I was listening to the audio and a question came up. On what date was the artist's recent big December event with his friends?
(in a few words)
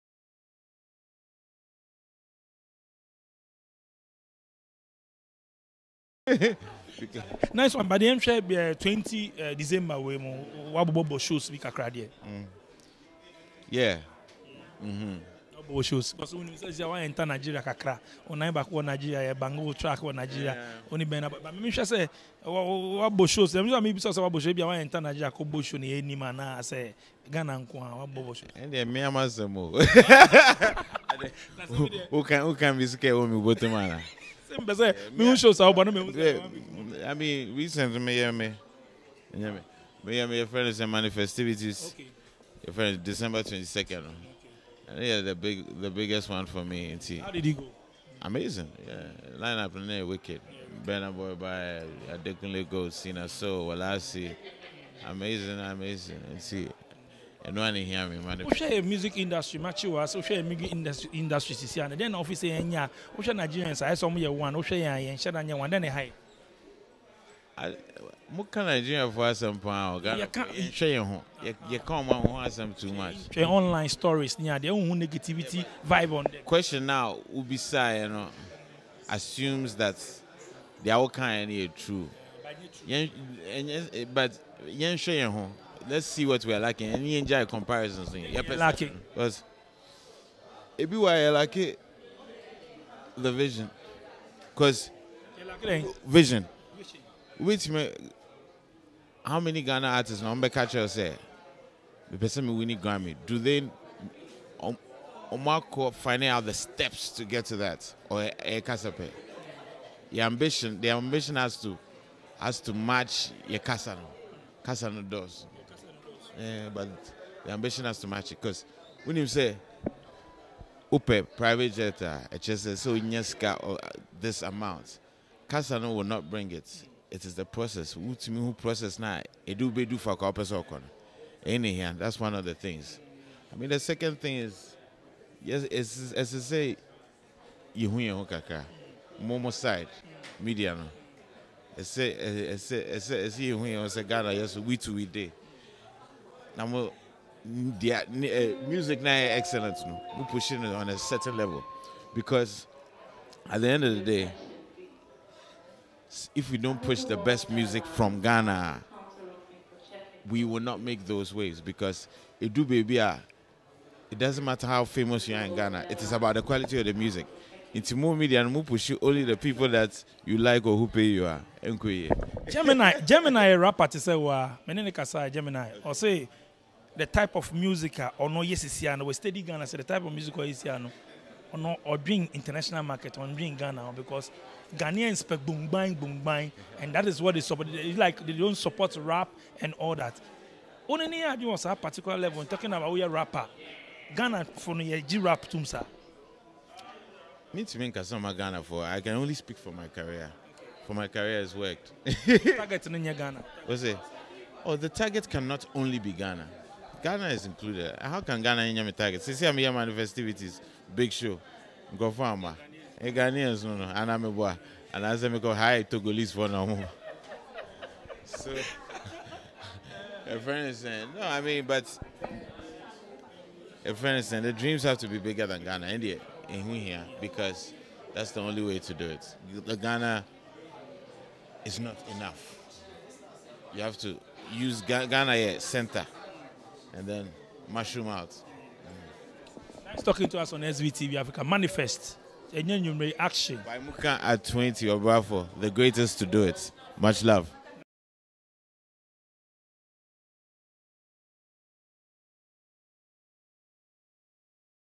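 December 22.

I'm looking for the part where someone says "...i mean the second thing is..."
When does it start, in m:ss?
2:13.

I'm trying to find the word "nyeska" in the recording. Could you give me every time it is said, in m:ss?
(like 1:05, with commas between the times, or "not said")
2:02.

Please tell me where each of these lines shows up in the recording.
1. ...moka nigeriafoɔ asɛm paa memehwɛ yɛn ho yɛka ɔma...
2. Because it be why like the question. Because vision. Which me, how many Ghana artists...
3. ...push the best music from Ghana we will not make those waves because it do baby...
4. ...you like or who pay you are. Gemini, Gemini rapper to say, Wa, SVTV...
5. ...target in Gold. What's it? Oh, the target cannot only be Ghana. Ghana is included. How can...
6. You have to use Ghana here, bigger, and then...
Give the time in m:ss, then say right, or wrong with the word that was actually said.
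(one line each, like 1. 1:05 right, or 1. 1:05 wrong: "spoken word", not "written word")
1. 1:08 wrong: "ɔgayɛhwɛ", not "memehwɛ"
2. 1:29 wrong: "vision", not "question"
3. 2:36 right
4. 2:50 wrong: "Menenikasa", not "SVTV"
5. 3:22 wrong: "Ghana", not "Gold"
6. 3:53 wrong: "center", not "bigger".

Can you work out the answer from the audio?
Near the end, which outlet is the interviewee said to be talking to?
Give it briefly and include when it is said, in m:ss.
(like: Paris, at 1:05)
SVTV Africa, at 4:00.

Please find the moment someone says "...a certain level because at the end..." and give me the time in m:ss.
2:30.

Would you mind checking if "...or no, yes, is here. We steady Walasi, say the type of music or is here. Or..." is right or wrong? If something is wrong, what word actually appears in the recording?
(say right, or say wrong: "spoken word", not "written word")
wrong: "Ghana", not "Walasi".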